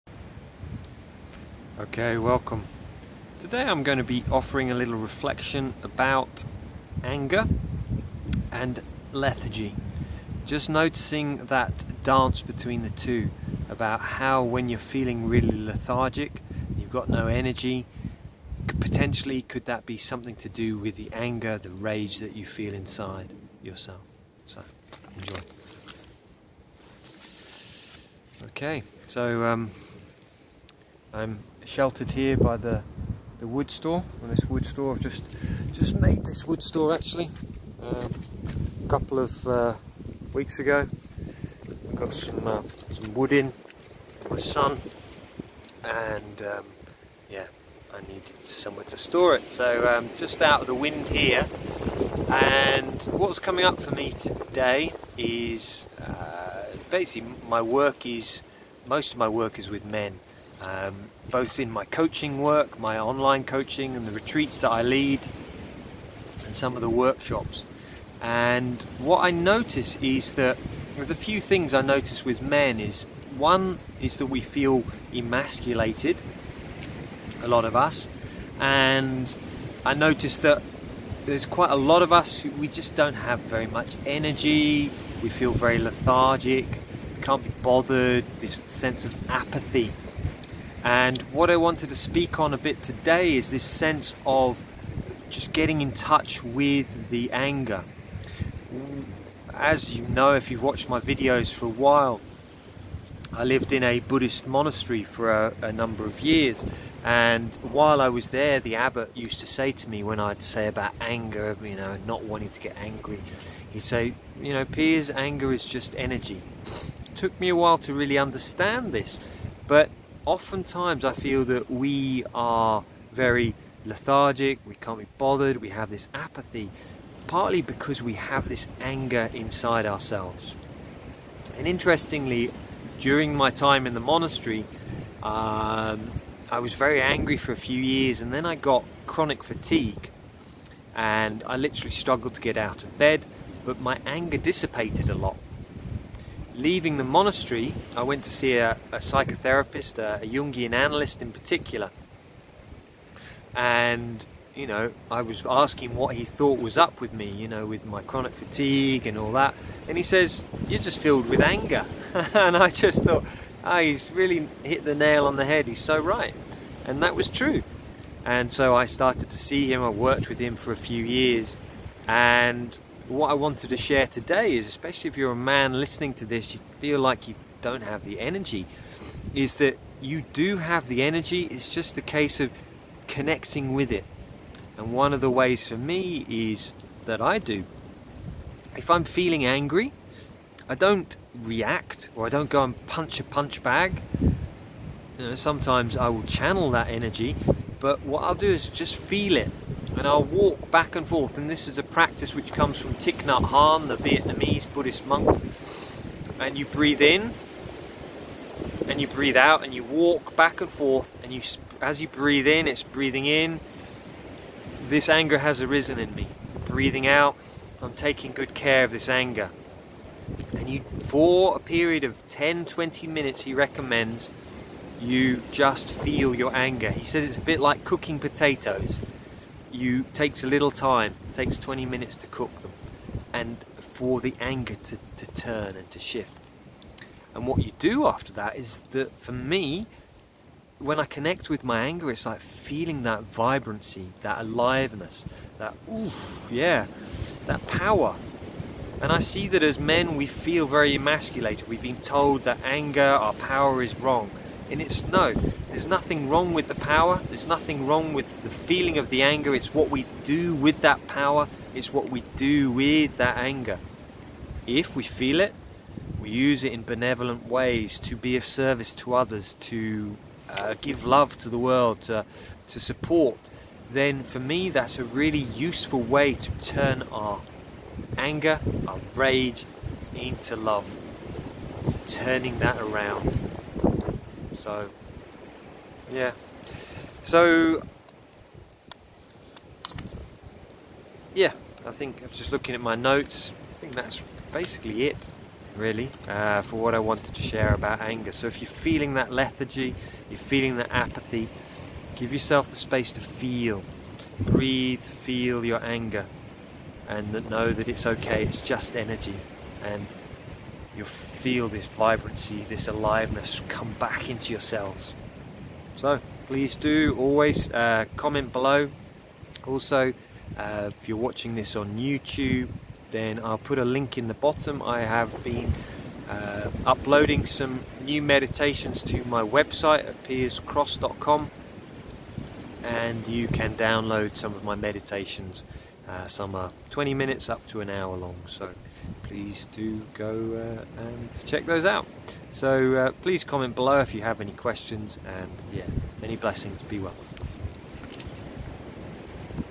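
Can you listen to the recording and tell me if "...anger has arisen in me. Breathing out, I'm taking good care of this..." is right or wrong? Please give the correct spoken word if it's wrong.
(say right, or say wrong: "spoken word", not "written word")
right.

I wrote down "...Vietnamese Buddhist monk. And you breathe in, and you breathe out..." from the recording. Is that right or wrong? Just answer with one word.
right.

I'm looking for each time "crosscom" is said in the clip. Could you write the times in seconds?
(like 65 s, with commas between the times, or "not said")
330 s.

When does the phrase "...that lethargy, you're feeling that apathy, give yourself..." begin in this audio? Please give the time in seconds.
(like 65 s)
299 s.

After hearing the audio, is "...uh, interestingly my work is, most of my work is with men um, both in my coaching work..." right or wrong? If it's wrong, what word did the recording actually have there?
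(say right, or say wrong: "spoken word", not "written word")
wrong: "basically", not "interestingly".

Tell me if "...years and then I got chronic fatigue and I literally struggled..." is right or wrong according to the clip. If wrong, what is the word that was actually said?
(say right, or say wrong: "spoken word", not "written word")
right.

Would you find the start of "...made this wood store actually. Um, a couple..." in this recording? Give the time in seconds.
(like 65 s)
35 s.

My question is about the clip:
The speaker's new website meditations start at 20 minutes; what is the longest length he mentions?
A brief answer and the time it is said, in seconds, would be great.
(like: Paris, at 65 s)
An hour, at 337 s.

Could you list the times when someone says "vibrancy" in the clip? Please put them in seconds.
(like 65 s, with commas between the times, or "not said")
243 s, 311 s.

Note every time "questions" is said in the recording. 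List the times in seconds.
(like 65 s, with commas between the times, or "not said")
344 s.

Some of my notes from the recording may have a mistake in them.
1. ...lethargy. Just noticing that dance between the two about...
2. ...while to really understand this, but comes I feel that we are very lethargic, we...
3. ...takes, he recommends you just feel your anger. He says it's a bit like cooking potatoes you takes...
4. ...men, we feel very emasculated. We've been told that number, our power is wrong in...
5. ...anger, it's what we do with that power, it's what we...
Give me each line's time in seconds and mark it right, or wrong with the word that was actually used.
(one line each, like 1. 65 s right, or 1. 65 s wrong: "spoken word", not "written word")
1. 9 s right
2. 117 s wrong: "oftentimes", not "comes"
3. 223 s wrong: "minutes", not "takes"
4. 249 s wrong: "anger", not "number"
5. 259 s right.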